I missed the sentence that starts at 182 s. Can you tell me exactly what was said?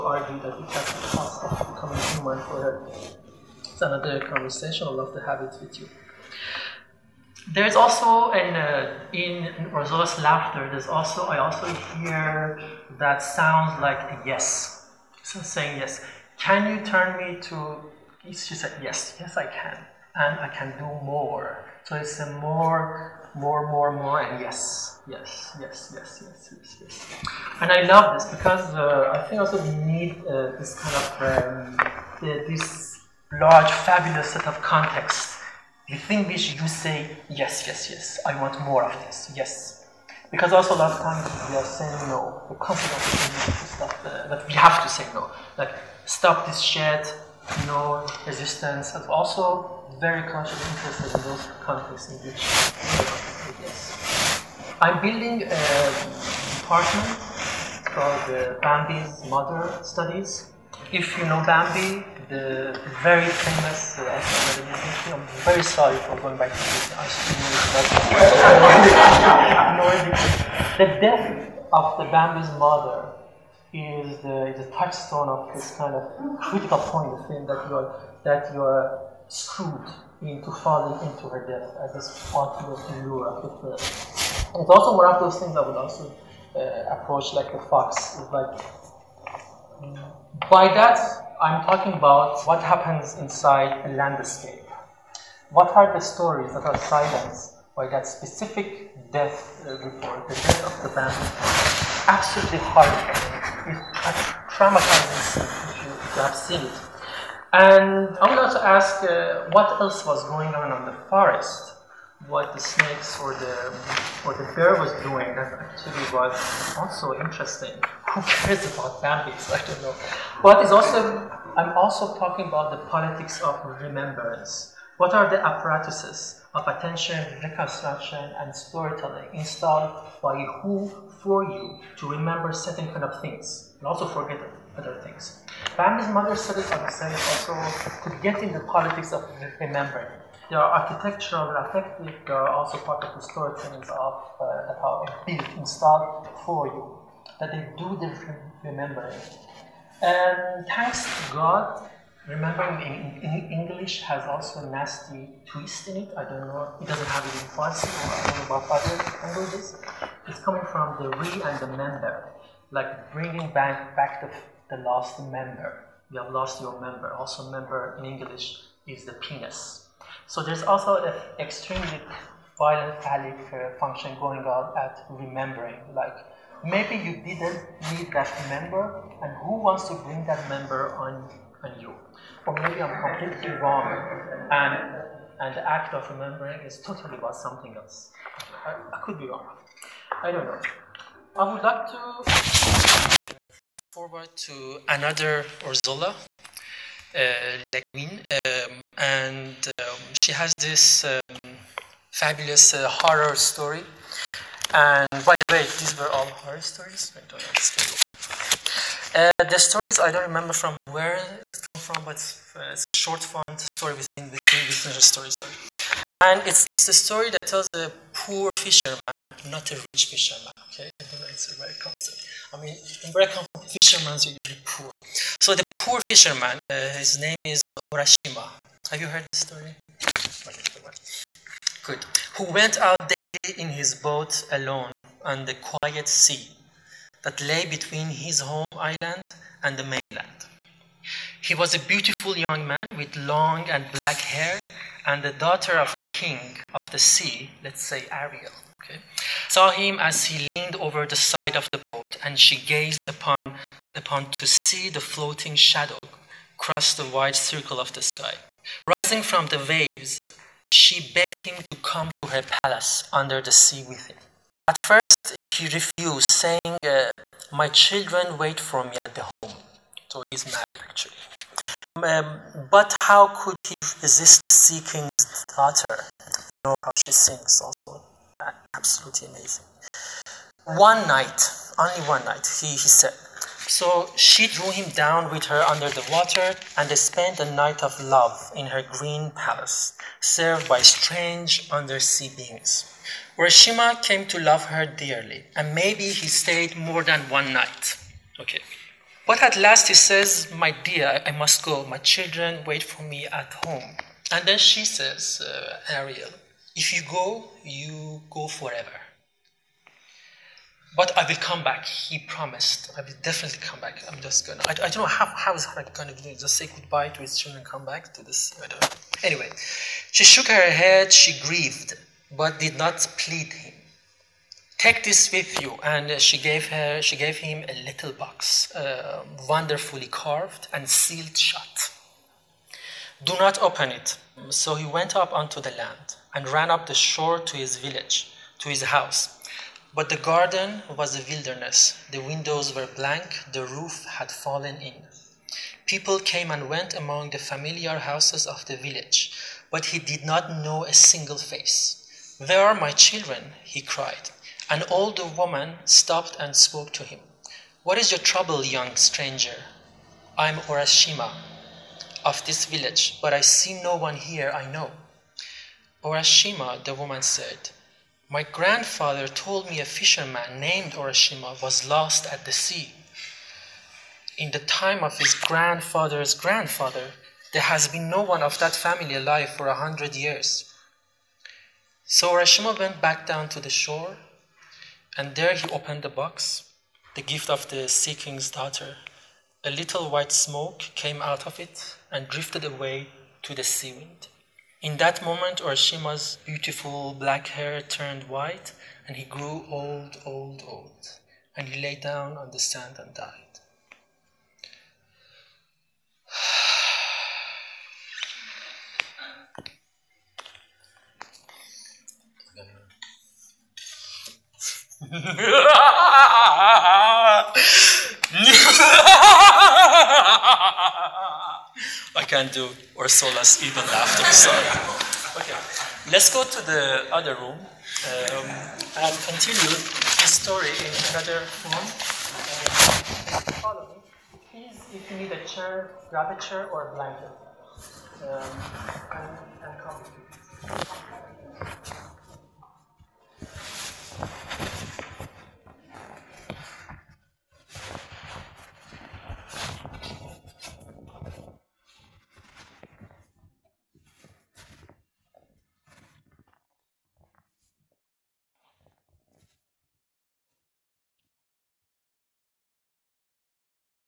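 Or maybe I'm completely wrong, and and the act of remembering is totally about something else.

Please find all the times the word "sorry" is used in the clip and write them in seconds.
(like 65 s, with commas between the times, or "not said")
65 s, 215 s.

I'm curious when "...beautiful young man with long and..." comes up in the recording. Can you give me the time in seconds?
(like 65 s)
241 s.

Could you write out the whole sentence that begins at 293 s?
Urashima came to love her dearly, and maybe he stayed more than one night.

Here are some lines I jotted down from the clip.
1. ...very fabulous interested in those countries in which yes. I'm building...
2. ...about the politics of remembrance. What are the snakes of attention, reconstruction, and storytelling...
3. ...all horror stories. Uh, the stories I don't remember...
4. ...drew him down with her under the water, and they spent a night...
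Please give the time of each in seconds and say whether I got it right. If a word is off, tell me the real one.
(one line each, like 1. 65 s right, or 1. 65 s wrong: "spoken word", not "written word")
1. 49 s wrong: "conscious", not "fabulous"
2. 122 s wrong: "apparatuses", not "snakes"
3. 206 s right
4. 284 s right.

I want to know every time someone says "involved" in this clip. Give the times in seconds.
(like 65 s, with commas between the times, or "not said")
not said.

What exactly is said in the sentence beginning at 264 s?
At first, he refused, saying, uh, My children wait for me at the home.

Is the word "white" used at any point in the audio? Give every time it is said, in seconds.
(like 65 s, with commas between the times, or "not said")
390 s, 398 s.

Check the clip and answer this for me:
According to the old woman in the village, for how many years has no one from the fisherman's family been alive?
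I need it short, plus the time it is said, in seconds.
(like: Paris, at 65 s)
100 years, at 379 s.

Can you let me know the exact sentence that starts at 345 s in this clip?
People came and went among the familiar houses of the village, but he did not know a single face.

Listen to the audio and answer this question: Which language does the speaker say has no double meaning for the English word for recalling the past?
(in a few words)
Farsi.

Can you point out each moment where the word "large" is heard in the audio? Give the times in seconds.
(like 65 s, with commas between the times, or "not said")
33 s.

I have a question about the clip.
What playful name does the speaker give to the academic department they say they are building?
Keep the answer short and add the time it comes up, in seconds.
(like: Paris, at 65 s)
Bambi's Mother Studies, at 58 s.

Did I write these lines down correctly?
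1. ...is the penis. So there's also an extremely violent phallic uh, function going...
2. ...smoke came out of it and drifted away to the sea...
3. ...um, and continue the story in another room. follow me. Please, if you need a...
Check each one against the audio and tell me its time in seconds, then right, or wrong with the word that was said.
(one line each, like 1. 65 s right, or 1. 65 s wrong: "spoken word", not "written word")
1. 168 s right
2. 390 s right
3. 427 s right.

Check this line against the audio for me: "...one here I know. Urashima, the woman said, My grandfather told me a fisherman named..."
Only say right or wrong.
right.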